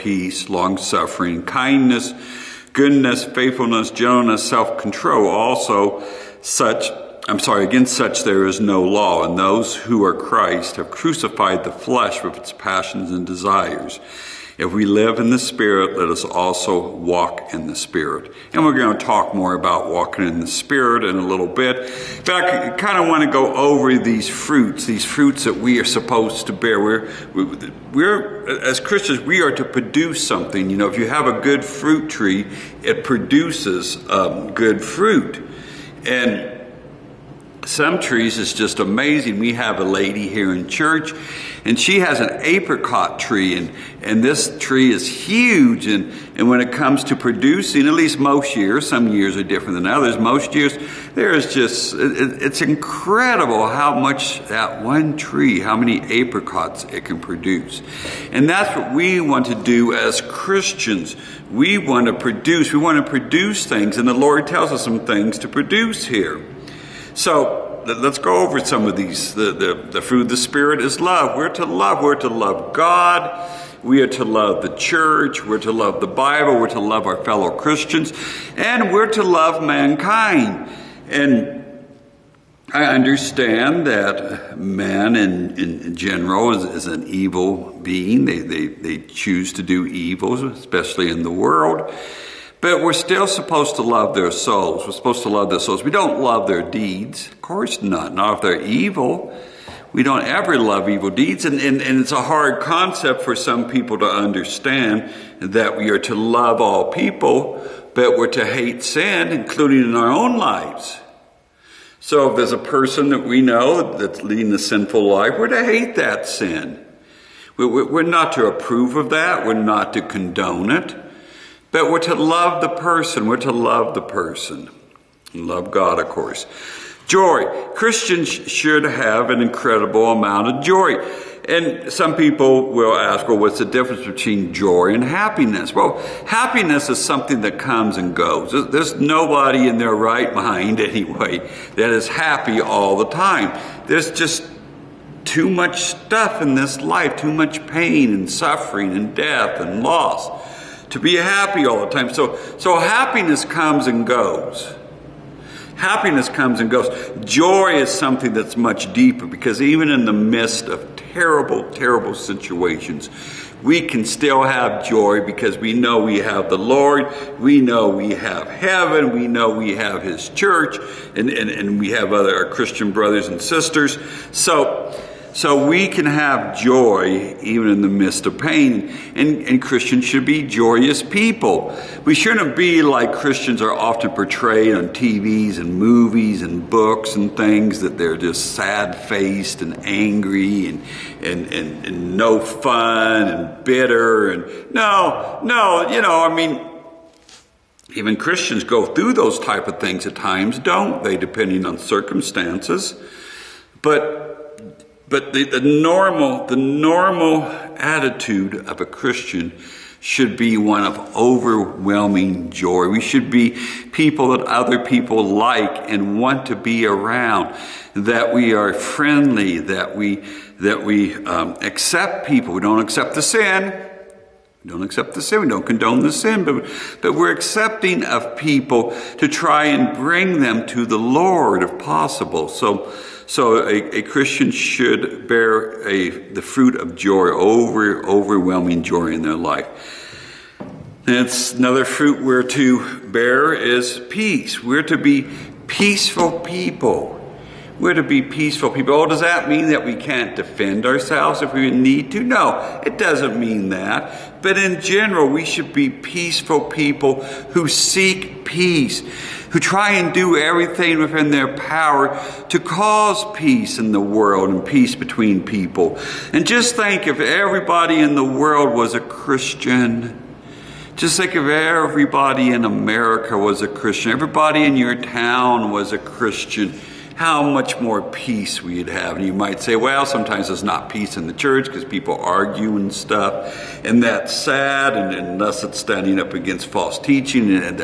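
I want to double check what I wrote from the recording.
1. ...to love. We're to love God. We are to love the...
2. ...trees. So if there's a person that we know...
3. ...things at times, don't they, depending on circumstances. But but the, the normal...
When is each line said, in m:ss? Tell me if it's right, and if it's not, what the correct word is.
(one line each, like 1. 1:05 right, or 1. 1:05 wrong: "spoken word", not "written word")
1. 1:11 right
2. 1:50 wrong: "lives", not "trees"
3. 3:19 right.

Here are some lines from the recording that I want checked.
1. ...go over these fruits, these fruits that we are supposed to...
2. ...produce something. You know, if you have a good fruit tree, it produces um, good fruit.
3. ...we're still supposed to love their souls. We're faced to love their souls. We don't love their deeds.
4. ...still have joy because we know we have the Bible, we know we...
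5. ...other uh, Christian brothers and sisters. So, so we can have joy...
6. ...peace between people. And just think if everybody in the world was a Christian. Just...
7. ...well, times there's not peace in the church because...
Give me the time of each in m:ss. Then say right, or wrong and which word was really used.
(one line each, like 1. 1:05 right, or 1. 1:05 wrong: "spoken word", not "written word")
1. 0:23 right
2. 0:29 right
3. 1:32 wrong: "supposed", not "faced"
4. 2:44 wrong: "Lord", not "Bible"
5. 2:52 right
6. 4:24 right
7. 4:39 wrong: "sometimes", not "times".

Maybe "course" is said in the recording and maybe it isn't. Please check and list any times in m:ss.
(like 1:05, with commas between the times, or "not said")
1:37, 2:06.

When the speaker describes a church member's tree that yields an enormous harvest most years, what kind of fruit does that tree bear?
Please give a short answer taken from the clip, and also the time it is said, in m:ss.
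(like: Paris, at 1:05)
Apricot, at 0:42.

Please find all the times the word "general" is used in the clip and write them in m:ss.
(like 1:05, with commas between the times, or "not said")
1:25, 4:14.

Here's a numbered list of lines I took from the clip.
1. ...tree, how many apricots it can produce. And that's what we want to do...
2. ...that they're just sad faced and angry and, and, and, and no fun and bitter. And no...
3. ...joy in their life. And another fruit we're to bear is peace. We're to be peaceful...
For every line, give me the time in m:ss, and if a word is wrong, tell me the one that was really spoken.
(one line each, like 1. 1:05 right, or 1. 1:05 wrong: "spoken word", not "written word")
1. 0:55 right
2. 3:07 right
3. 3:58 right.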